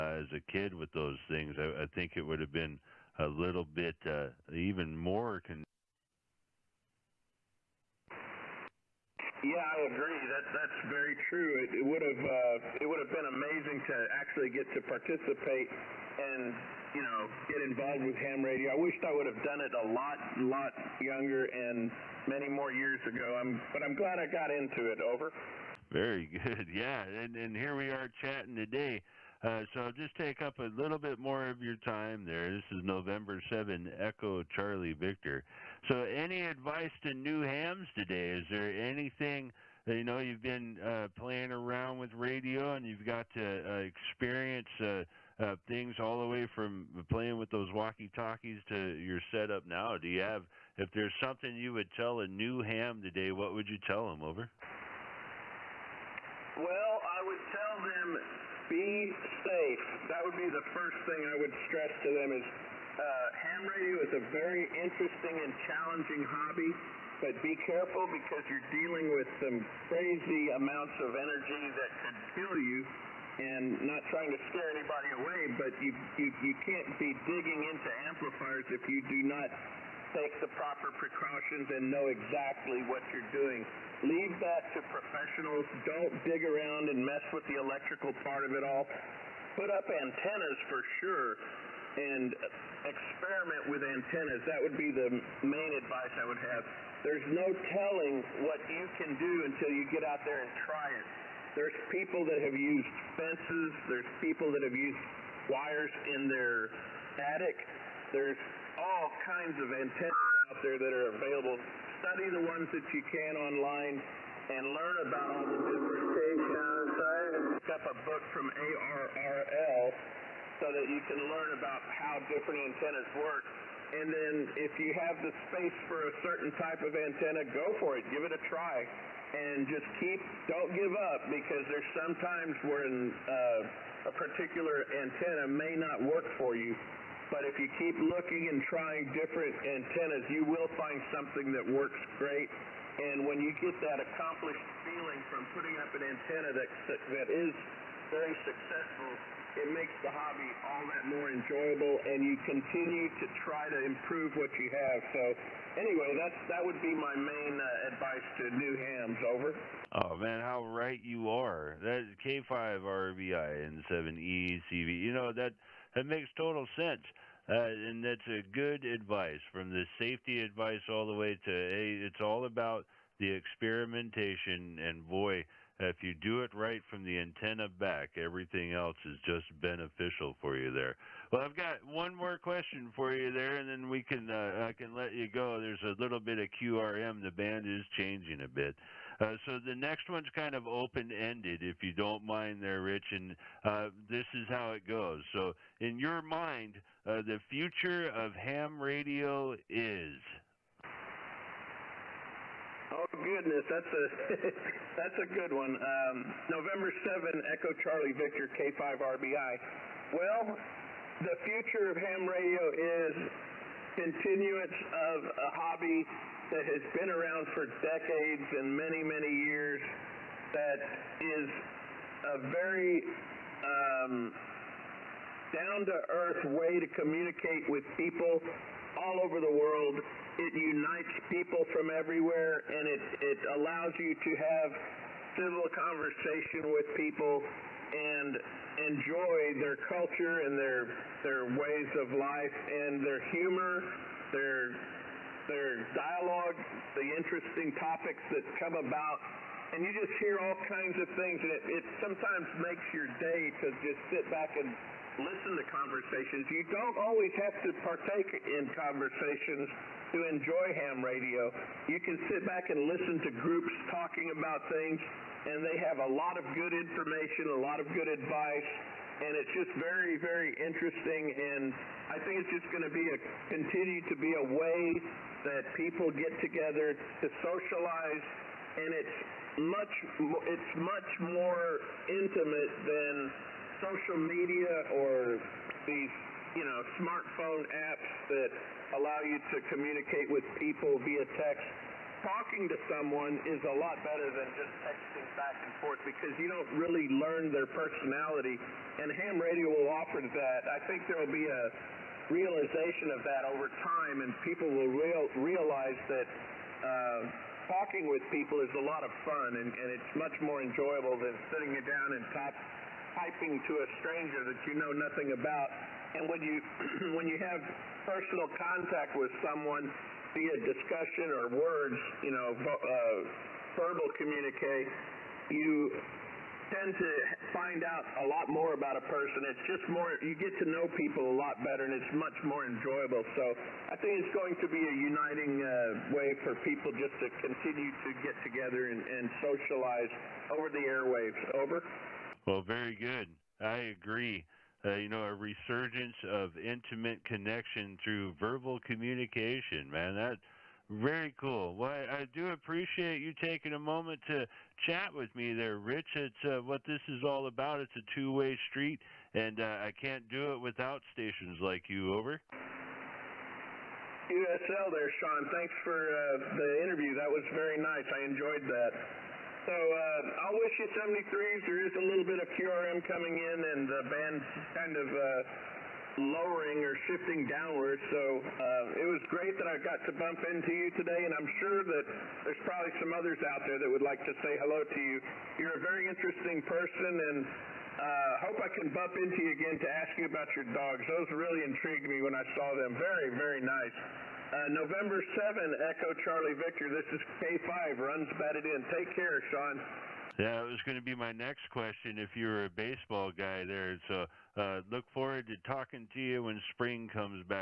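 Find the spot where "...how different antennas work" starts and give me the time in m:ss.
2:01.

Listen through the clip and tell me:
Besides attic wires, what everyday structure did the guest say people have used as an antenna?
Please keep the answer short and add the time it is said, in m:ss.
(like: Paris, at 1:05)
Fences, at 1:43.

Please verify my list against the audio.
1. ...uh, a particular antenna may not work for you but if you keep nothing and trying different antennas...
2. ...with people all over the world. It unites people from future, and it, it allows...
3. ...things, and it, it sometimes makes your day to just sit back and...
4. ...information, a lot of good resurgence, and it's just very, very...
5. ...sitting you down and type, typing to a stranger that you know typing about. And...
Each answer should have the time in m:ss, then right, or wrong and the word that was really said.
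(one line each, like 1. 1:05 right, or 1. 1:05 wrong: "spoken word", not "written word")
1. 2:12 wrong: "looking", not "nothing"
2. 3:47 wrong: "everywhere", not "future"
3. 4:11 right
4. 4:26 wrong: "advice", not "resurgence"
5. 5:11 wrong: "nothing", not "typing".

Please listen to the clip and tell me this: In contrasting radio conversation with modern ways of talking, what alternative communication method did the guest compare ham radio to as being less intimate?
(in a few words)
Social media.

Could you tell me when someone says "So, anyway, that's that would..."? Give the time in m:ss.
2:35.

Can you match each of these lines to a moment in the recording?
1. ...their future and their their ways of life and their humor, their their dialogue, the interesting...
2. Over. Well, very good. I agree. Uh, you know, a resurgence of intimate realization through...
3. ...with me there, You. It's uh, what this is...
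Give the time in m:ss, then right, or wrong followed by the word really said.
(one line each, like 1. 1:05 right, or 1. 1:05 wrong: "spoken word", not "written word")
1. 3:59 wrong: "culture", not "future"
2. 5:41 wrong: "connection", not "realization"
3. 5:55 wrong: "Rich", not "You".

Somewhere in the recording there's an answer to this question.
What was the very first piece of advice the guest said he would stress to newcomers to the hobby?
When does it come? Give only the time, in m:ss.
0:58.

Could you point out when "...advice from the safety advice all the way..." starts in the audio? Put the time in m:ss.
2:48.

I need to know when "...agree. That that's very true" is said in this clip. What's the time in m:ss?
0:09.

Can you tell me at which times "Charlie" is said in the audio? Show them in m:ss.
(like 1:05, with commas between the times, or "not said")
0:34, 3:27, 6:36.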